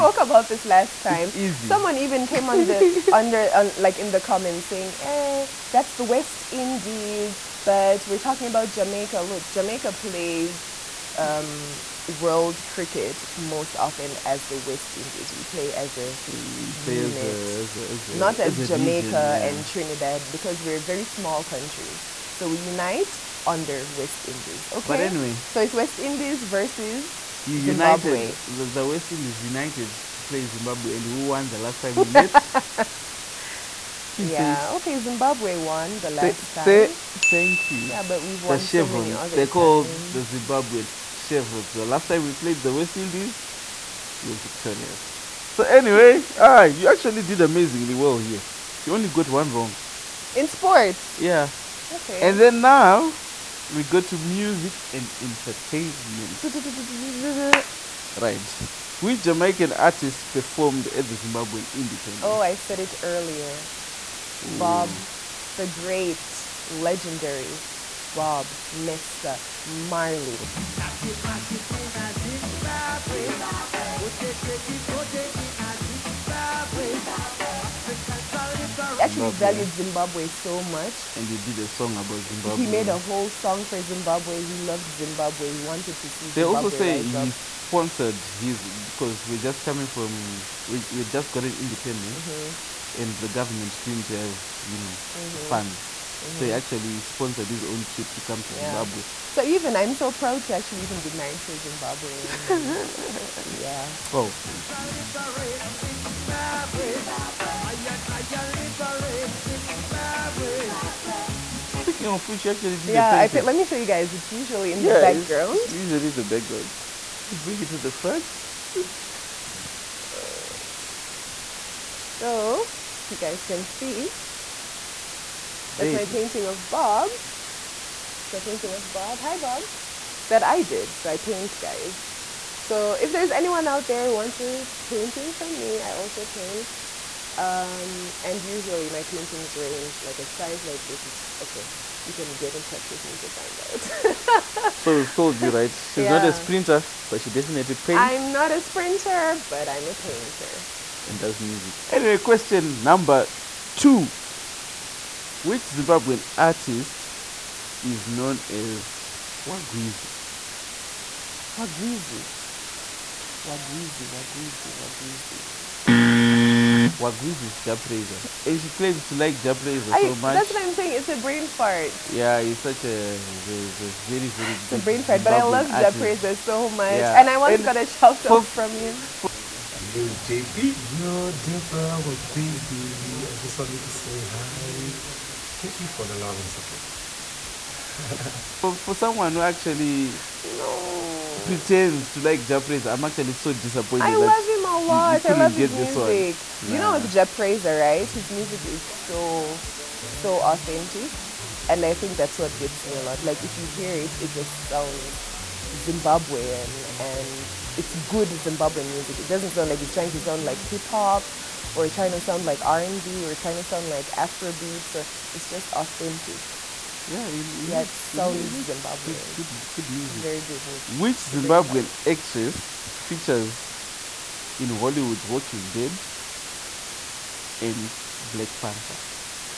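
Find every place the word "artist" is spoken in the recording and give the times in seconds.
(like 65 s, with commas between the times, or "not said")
59 s, 156 s.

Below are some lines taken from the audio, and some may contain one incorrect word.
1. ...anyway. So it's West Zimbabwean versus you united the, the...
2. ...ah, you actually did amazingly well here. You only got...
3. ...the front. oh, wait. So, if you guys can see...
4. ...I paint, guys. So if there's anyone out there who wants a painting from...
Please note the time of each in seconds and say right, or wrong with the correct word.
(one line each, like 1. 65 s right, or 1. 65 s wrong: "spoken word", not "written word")
1. 25 s wrong: "Indies", not "Zimbabwean"
2. 46 s right
3. 117 s right
4. 131 s right.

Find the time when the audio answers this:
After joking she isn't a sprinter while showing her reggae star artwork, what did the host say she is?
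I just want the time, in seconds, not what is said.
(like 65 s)
149 s.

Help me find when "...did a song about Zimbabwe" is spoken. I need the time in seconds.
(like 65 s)
81 s.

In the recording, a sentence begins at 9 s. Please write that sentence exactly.
Look, Jamaica plays um, world cricket most often as the West Indies.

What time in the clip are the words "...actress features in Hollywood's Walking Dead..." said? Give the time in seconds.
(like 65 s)
222 s.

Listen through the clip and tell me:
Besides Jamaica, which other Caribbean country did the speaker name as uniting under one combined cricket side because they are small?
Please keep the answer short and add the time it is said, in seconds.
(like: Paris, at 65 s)
Trinidad, at 19 s.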